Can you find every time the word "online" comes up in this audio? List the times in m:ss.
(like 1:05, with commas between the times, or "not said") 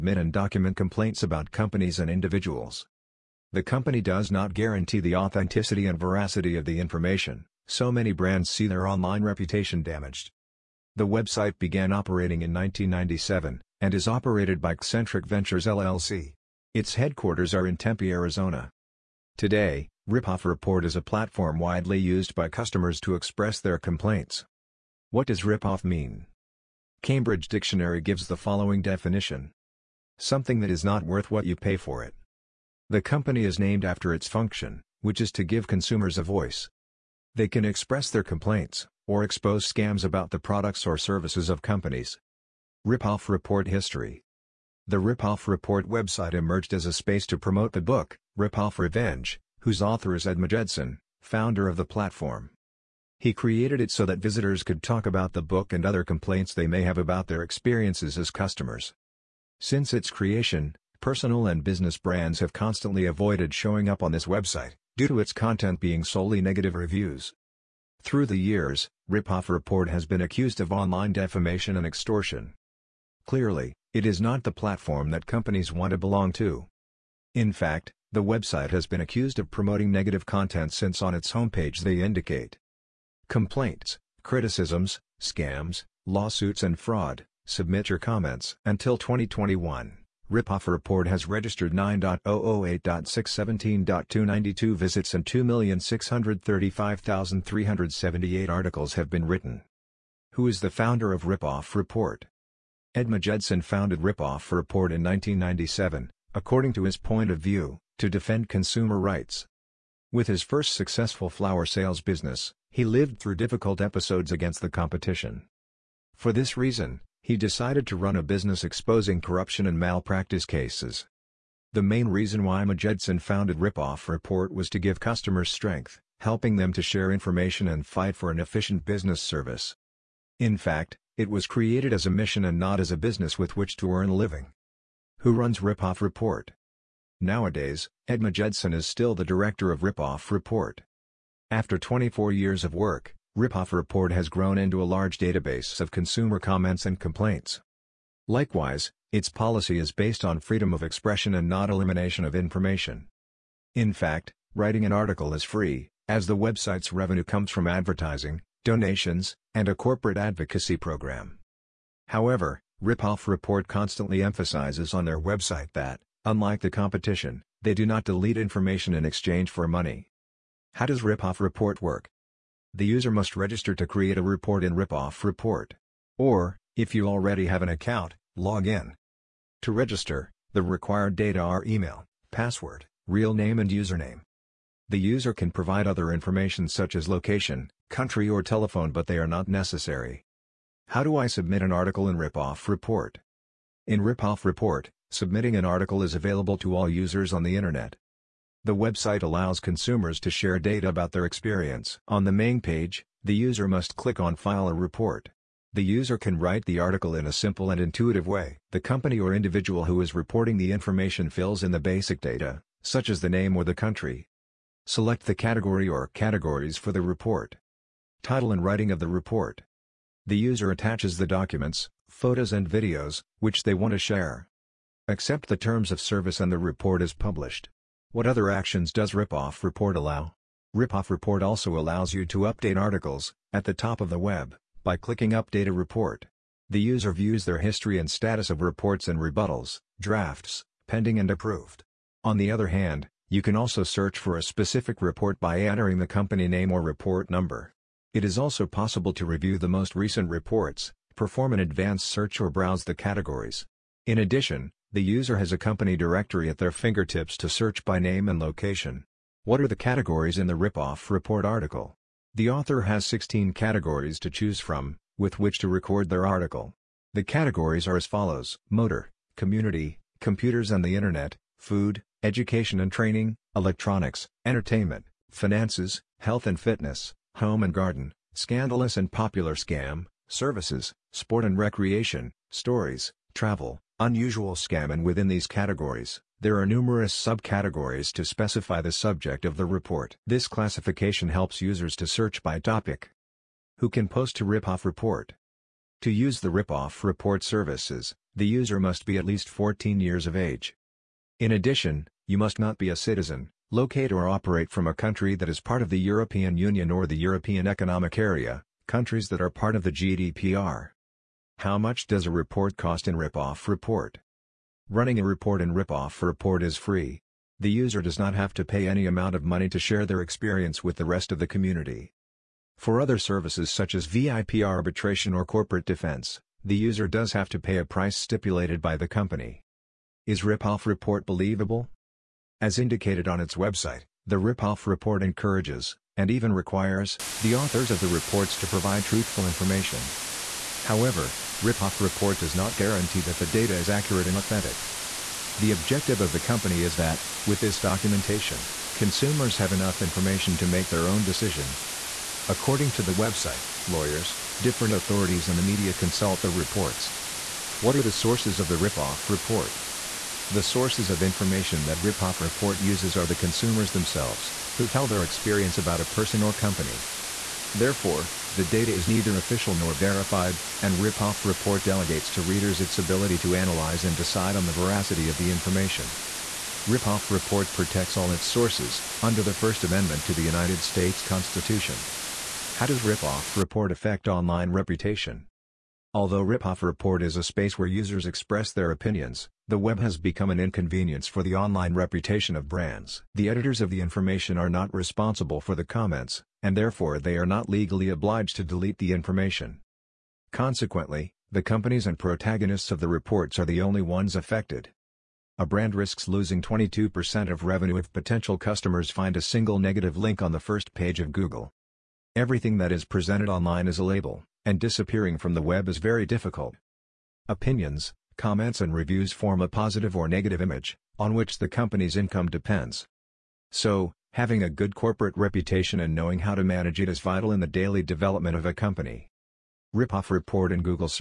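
0:08, 1:10, 6:24, 6:31, 6:53.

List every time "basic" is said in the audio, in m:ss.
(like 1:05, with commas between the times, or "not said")
3:31.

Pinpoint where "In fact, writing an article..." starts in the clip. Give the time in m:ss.
2:33.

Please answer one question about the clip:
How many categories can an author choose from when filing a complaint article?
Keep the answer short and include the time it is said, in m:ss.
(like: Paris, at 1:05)
16, at 4:23.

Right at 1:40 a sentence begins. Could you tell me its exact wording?
Who is the founder of Ripoff Report?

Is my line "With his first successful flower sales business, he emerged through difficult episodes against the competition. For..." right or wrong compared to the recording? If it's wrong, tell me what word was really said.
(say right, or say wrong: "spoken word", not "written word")
wrong: "lived", not "emerged".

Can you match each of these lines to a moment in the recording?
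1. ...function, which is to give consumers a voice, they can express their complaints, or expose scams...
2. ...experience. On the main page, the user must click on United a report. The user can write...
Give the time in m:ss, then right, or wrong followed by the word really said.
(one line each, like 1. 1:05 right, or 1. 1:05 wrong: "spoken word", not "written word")
1. 0:34 right
2. 3:21 wrong: "File", not "United".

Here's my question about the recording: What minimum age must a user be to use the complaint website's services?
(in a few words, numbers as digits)
14.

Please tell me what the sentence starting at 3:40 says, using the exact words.
The user attaches the documents, photos and videos, which they want to share.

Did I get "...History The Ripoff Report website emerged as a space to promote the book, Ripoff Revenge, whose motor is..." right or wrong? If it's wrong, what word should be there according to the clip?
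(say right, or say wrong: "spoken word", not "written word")
wrong: "author", not "motor".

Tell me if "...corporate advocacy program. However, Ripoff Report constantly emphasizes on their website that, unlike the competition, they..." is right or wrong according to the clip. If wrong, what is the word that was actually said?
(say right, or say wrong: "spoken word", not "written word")
right.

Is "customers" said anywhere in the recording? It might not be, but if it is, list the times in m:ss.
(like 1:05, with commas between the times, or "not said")
0:22, 0:58, 2:04, 6:48.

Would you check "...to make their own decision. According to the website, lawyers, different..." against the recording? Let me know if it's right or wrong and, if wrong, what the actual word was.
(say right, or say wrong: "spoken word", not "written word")
right.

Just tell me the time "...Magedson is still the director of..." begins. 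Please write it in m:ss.
2:18.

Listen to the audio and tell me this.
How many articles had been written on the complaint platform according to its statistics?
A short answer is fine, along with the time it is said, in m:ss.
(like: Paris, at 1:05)
2,635,378, at 1:35.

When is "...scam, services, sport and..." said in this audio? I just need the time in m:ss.
4:39.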